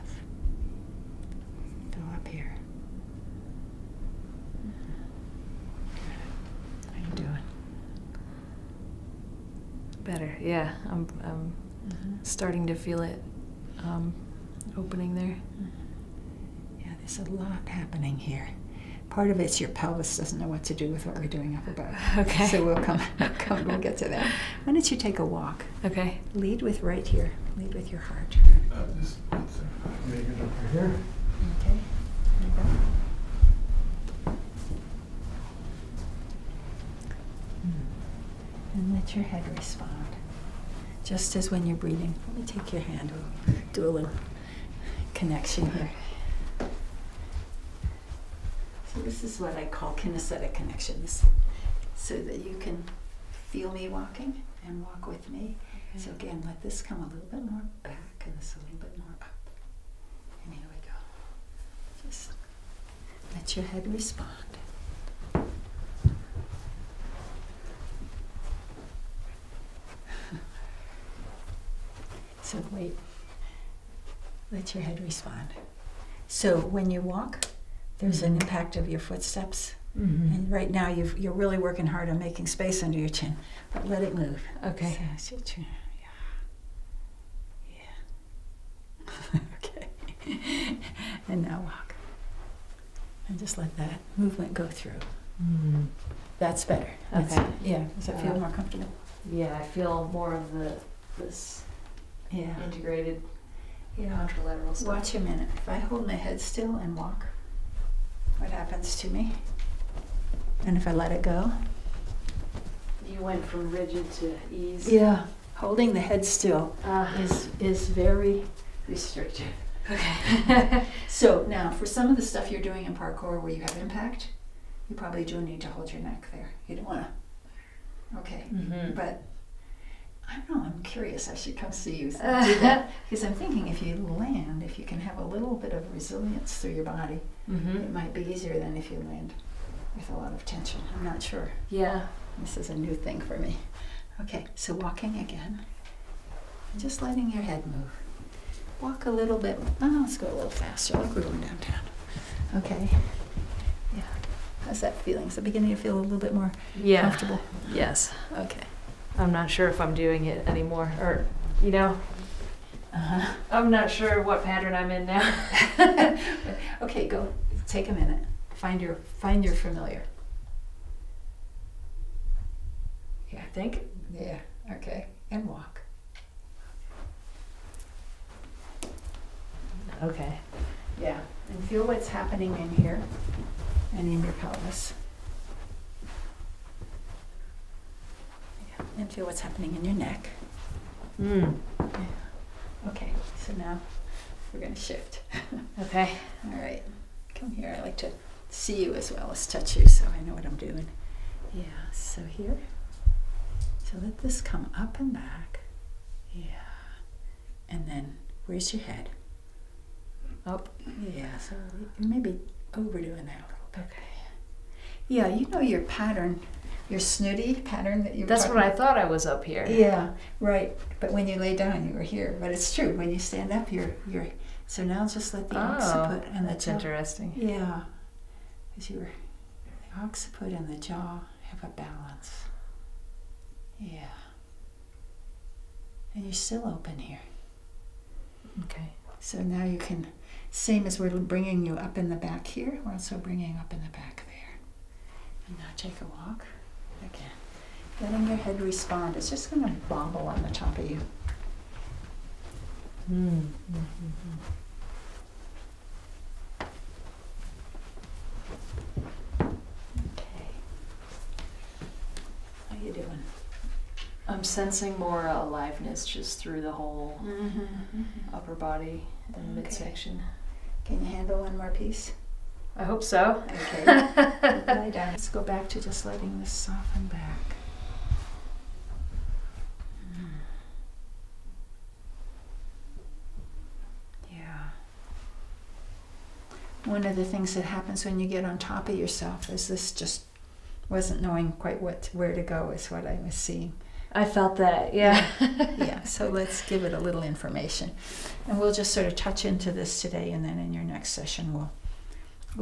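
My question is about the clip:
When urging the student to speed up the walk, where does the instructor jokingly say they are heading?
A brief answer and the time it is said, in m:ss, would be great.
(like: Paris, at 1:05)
downtown, at 2:31.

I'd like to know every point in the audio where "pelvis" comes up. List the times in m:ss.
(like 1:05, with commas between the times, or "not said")
0:19, 3:04.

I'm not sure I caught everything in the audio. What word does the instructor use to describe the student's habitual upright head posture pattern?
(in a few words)
snooty.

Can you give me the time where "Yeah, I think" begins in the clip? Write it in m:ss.
2:53.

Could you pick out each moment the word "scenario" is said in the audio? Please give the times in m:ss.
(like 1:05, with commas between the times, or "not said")
not said.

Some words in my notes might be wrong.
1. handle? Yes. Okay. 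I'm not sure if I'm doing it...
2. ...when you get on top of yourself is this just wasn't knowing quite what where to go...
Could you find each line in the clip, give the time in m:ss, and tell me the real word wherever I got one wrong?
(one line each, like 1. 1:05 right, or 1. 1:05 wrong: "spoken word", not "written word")
1. 2:37 wrong: "comfortable", not "handle"
2. 4:48 right.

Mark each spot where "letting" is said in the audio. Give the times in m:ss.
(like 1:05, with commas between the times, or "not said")
2:27, 4:07, 4:36.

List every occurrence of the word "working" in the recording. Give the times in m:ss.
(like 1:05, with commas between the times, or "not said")
1:21.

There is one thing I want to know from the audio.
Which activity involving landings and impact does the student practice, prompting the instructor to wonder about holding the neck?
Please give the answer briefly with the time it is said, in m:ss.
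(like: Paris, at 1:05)
parkour, at 2:02.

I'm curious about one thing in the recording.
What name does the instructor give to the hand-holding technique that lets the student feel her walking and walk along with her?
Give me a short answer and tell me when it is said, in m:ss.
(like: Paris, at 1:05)
kinesthetic connections, at 0:49.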